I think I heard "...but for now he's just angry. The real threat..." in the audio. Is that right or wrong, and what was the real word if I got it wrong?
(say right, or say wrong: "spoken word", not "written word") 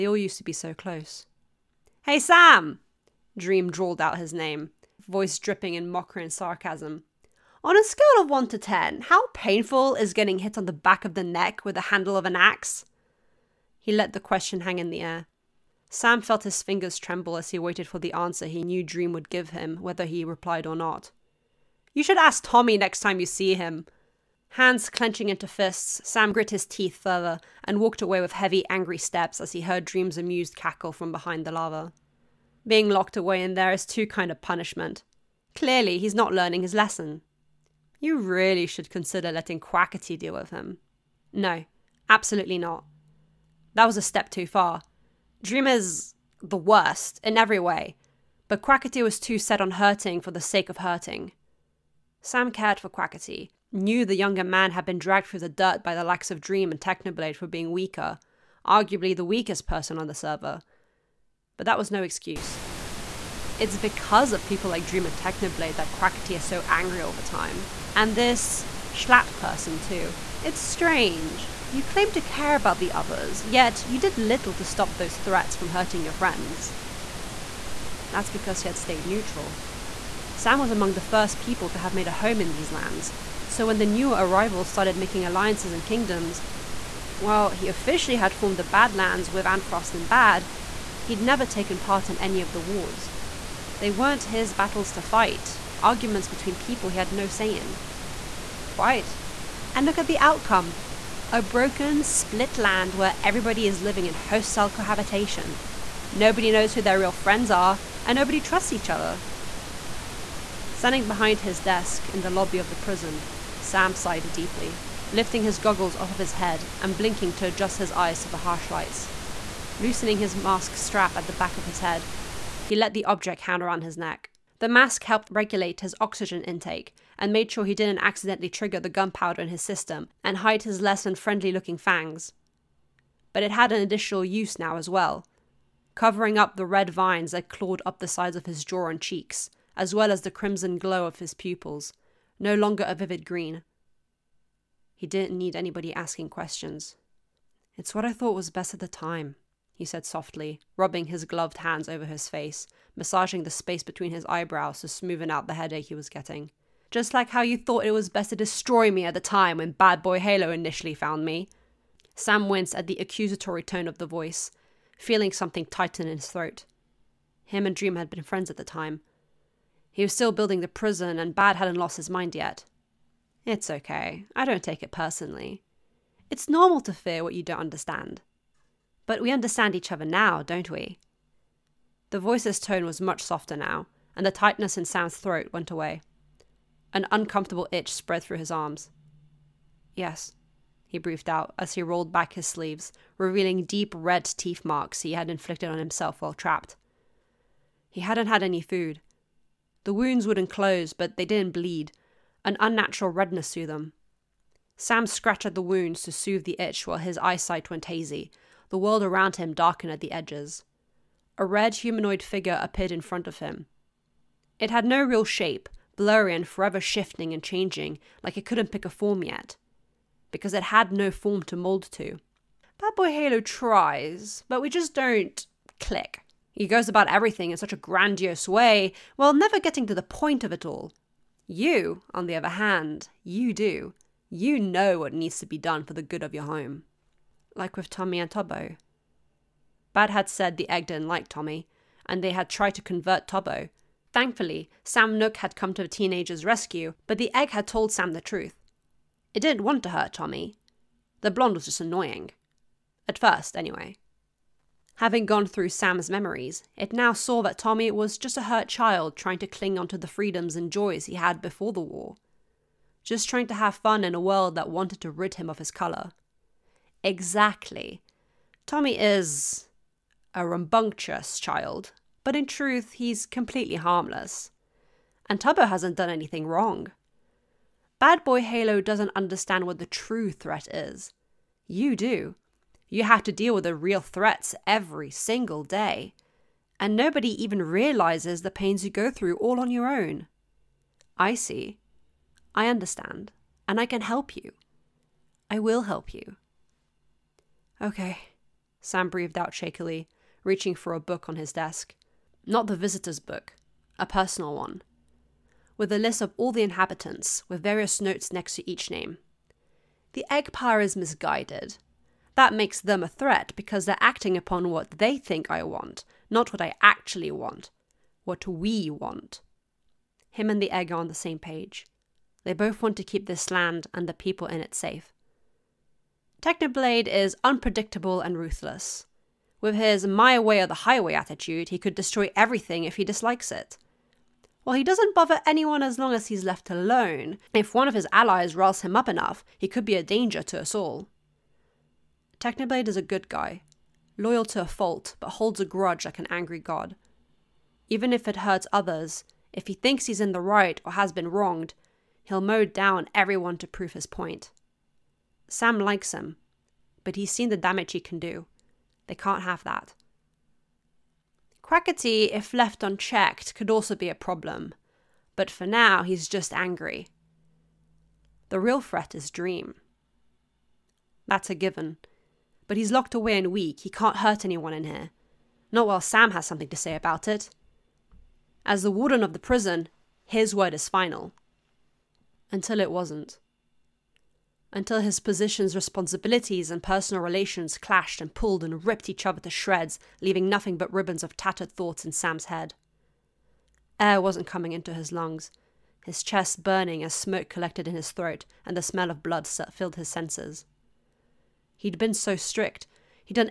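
right.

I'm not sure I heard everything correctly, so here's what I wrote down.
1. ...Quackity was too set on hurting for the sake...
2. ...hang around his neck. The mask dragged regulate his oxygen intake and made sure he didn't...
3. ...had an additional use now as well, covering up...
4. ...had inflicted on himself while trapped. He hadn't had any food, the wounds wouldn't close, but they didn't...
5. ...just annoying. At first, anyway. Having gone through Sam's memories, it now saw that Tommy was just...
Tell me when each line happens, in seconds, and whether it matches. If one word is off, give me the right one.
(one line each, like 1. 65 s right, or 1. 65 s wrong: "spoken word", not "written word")
1. 48 s right
2. 123 s wrong: "helped", not "dragged"
3. 133 s right
4. 195 s right
5. 251 s right.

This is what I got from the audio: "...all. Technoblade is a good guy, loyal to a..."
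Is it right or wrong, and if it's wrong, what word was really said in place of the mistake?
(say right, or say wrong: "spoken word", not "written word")
right.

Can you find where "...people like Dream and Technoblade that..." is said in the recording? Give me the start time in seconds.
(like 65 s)
64 s.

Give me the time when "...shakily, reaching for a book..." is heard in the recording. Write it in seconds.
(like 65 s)
299 s.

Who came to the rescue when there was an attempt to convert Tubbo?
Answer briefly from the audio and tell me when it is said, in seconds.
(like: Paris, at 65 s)
Sam Nook, at 244 s.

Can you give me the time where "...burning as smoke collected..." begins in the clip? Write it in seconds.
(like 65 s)
396 s.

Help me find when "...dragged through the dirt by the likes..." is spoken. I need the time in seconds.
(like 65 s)
54 s.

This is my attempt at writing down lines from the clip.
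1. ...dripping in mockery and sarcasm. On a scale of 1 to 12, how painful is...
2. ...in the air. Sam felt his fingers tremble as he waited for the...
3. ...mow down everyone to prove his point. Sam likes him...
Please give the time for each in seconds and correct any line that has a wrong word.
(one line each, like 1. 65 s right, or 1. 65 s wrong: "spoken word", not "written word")
1. 5 s wrong: "10", not "12"
2. 14 s right
3. 352 s right.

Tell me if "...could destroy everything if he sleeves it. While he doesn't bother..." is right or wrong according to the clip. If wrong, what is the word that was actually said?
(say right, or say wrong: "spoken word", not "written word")
wrong: "dislikes", not "sleeves".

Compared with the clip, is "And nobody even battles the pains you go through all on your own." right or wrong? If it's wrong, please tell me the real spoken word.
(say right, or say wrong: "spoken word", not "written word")
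wrong: "realizes", not "battles".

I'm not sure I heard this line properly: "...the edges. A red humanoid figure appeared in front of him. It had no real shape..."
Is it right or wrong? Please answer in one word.
right.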